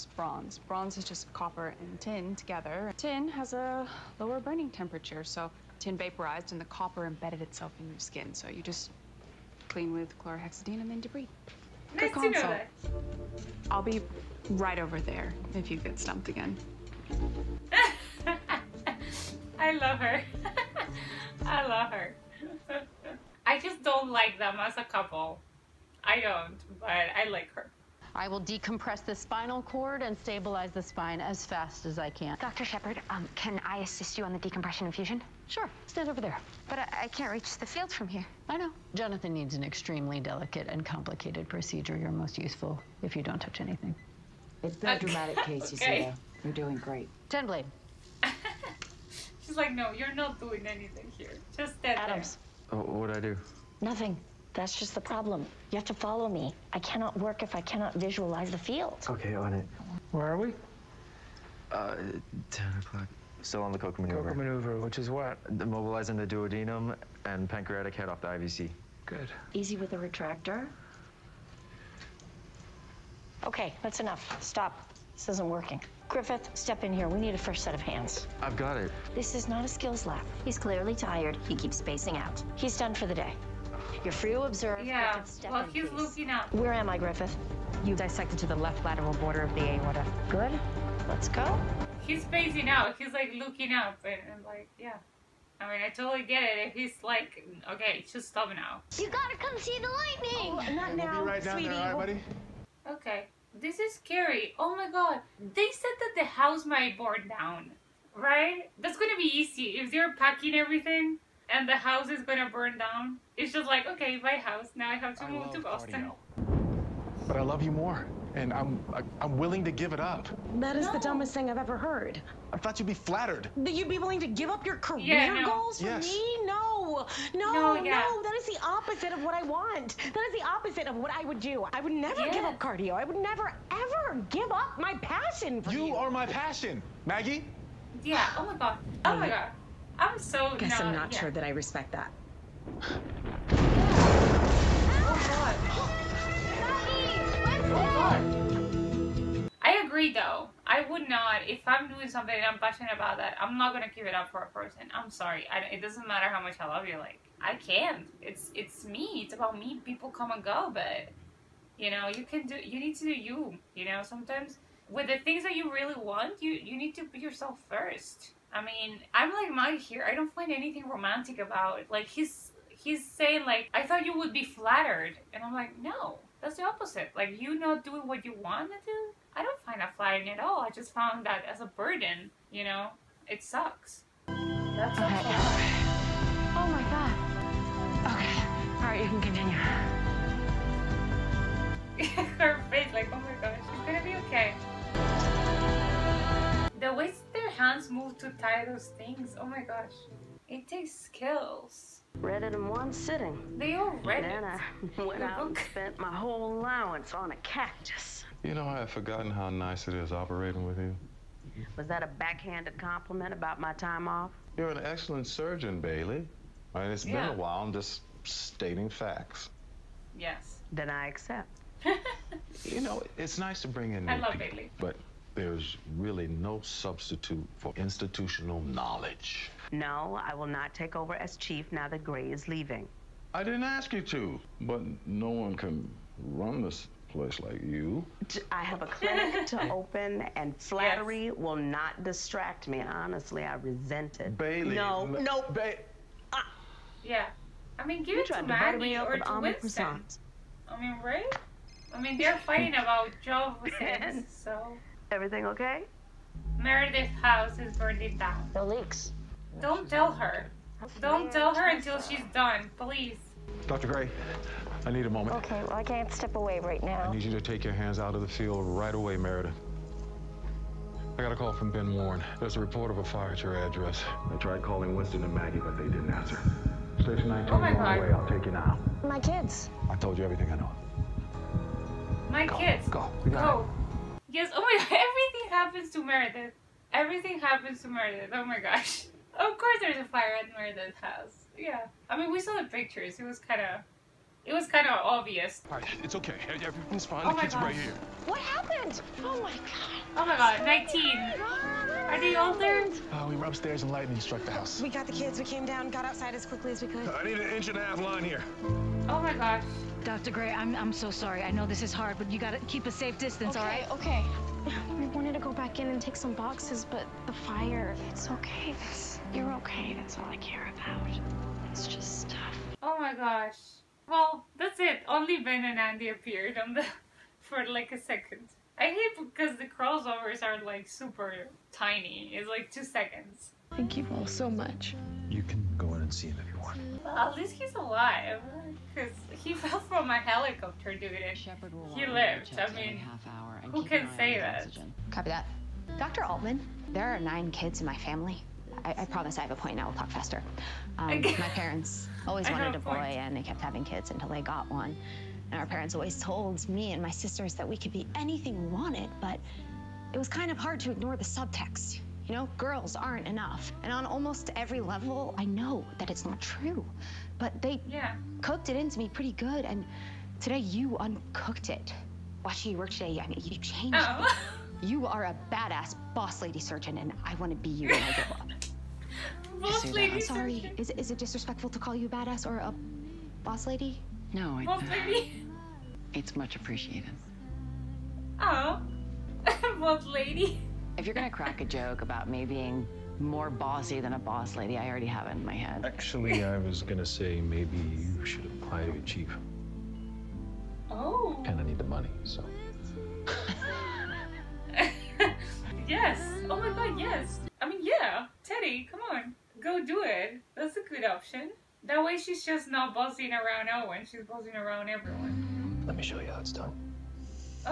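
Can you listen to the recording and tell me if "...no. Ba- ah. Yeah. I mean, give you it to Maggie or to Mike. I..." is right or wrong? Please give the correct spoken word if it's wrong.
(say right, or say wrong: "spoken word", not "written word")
wrong: "Winston", not "Mike".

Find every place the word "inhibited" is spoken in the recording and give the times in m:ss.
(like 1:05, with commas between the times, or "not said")
not said.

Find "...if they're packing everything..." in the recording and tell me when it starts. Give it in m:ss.
1:49.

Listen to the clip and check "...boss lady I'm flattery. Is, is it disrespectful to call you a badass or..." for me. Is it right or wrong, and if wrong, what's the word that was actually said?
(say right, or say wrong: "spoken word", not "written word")
wrong: "sorry", not "flattery".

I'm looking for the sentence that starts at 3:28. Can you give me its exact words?
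You know, I have forgotten how nice it is operating with you.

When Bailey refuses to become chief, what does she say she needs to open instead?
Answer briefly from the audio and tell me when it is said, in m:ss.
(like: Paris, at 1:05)
a clinic, at 3:58.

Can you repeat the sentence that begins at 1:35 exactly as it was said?
I mean, I totally get it.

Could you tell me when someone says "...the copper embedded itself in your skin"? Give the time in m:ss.
0:06.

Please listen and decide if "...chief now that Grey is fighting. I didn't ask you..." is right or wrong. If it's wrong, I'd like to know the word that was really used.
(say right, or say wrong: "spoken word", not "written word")
wrong: "leaving", not "fighting".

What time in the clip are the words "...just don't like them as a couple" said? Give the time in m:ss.
0:23.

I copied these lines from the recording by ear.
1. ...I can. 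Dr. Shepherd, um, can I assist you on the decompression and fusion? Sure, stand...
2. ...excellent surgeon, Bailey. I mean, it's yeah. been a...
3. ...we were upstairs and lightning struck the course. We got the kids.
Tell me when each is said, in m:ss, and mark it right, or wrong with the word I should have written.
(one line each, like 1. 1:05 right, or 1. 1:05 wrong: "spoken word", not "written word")
1. 0:31 right
2. 3:34 right
3. 5:03 wrong: "house", not "course".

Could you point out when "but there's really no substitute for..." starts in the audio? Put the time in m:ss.
3:44.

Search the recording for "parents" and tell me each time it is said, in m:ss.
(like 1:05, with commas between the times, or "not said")
5:51, 5:55.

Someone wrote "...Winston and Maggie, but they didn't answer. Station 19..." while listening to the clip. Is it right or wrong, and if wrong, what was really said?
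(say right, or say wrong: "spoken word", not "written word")
right.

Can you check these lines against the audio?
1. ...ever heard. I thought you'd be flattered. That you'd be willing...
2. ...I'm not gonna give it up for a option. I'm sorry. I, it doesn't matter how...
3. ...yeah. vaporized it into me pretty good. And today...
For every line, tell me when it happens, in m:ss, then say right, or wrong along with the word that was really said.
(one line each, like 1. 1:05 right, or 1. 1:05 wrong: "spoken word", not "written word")
1. 2:01 right
2. 2:33 wrong: "person", not "option"
3. 6:07 wrong: "cooked", not "vaporized".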